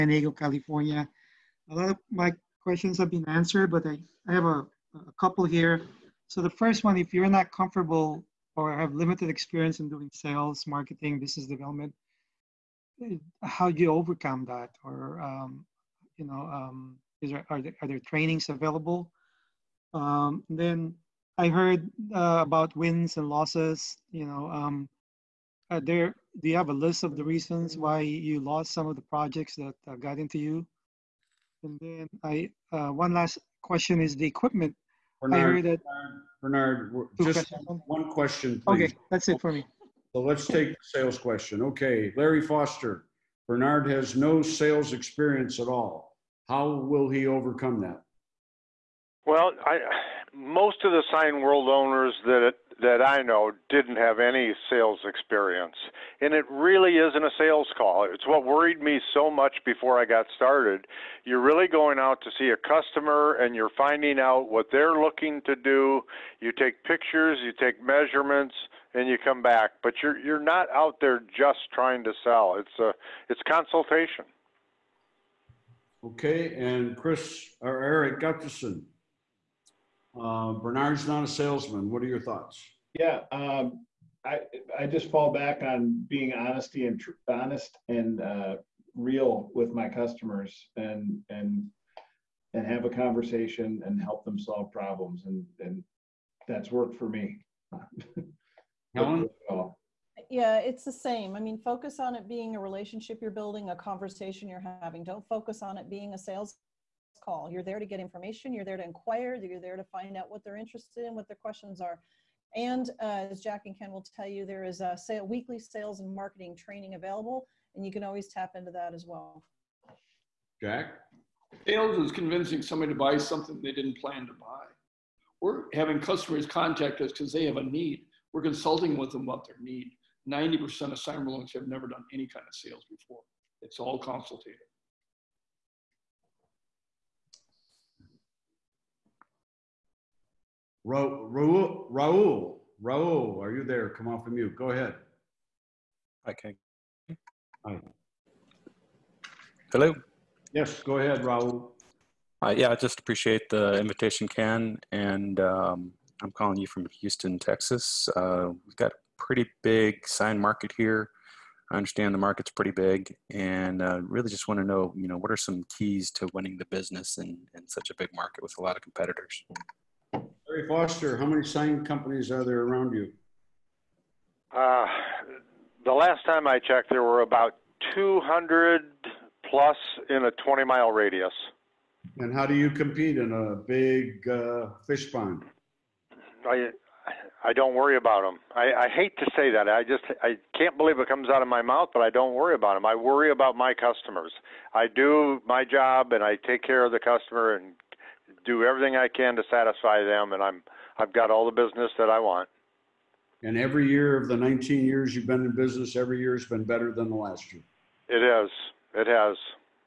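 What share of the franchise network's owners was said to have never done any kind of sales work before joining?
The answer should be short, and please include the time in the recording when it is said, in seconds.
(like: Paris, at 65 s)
90%, at 130 s.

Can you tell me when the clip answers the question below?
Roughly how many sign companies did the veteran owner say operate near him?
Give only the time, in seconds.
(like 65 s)
177 s.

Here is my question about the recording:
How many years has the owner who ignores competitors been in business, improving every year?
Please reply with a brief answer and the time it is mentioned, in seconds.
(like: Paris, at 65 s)
19, at 204 s.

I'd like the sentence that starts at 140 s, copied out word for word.
Raul, Raul, Raul, are you there?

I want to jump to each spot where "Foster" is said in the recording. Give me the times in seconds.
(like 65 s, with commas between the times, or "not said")
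42 s, 170 s.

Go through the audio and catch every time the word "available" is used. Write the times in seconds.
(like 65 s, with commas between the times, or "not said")
18 s, 116 s.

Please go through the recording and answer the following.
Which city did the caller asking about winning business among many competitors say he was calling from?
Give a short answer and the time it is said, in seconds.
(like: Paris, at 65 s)
Houston, Texas, at 157 s.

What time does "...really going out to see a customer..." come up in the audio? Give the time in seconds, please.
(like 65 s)
61 s.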